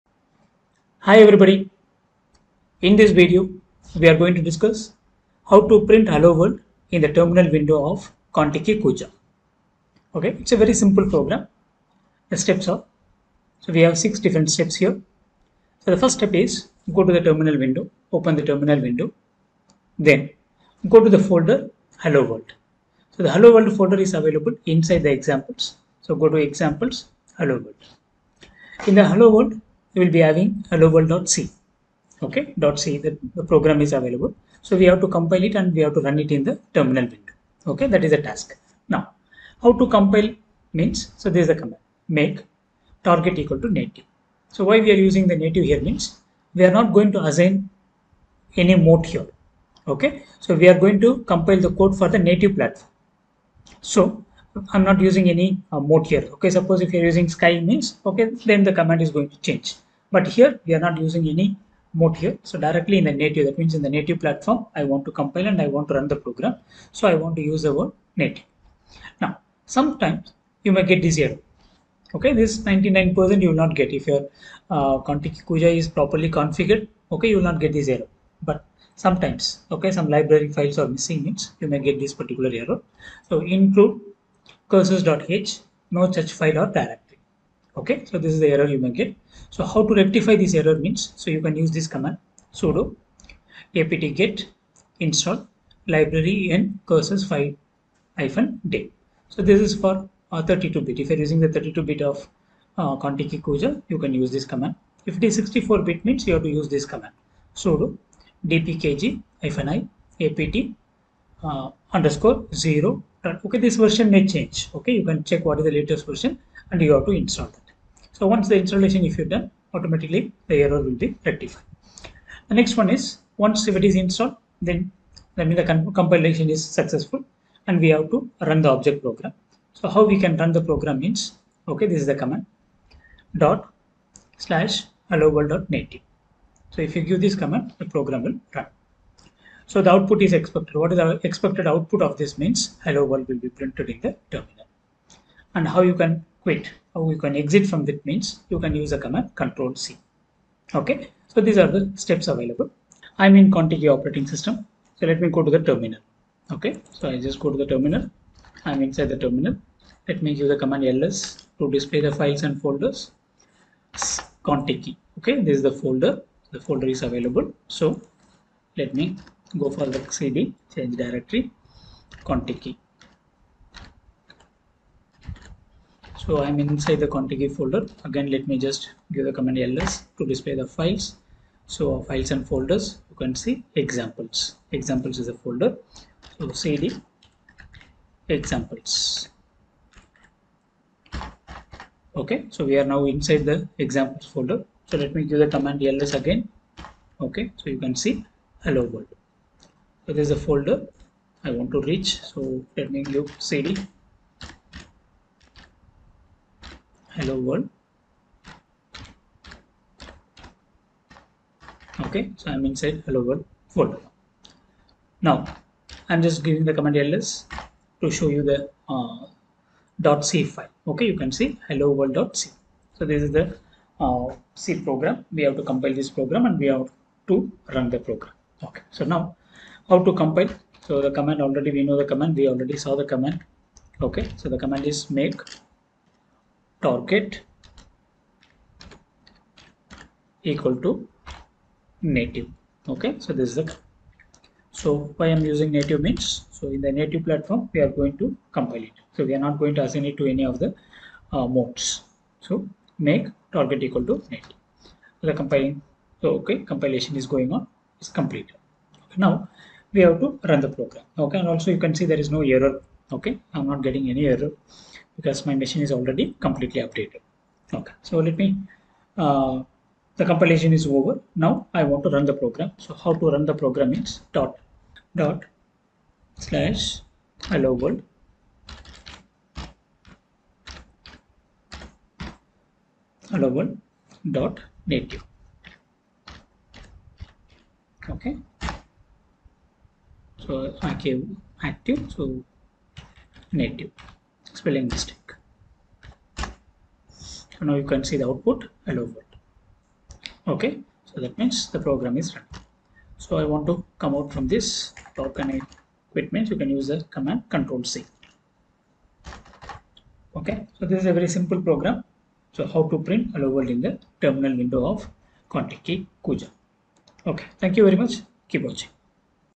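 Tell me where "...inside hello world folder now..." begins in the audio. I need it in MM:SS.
03:32.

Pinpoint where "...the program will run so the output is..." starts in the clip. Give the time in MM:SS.
02:17.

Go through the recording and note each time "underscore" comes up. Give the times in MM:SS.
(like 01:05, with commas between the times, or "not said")
01:51.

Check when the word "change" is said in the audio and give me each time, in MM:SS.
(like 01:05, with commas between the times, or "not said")
00:59, 01:54, 02:50.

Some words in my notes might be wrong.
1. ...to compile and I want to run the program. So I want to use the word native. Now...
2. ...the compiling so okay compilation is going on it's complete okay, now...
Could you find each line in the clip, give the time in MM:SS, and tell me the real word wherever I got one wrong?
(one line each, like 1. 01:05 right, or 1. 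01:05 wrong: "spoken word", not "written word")
1. 01:05 right
2. 04:15 right.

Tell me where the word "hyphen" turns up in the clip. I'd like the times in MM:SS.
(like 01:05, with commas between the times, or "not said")
01:38.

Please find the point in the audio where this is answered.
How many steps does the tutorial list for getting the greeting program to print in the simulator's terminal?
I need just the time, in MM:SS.
00:13.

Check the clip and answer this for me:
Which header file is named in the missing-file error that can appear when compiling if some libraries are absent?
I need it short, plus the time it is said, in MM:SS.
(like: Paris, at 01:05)
Curses.h, at 01:24.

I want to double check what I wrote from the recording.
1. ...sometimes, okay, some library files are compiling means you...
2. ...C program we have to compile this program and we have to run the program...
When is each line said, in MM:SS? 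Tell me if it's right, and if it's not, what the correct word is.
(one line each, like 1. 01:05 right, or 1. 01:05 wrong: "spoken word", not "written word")
1. 01:18 wrong: "missing", not "compiling"
2. 03:44 right.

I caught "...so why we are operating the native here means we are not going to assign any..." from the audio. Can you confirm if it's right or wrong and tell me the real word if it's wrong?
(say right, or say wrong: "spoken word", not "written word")
wrong: "using", not "operating".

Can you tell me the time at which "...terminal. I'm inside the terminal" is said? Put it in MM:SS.
02:37.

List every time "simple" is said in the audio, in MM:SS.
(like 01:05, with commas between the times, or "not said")
00:10, 05:11.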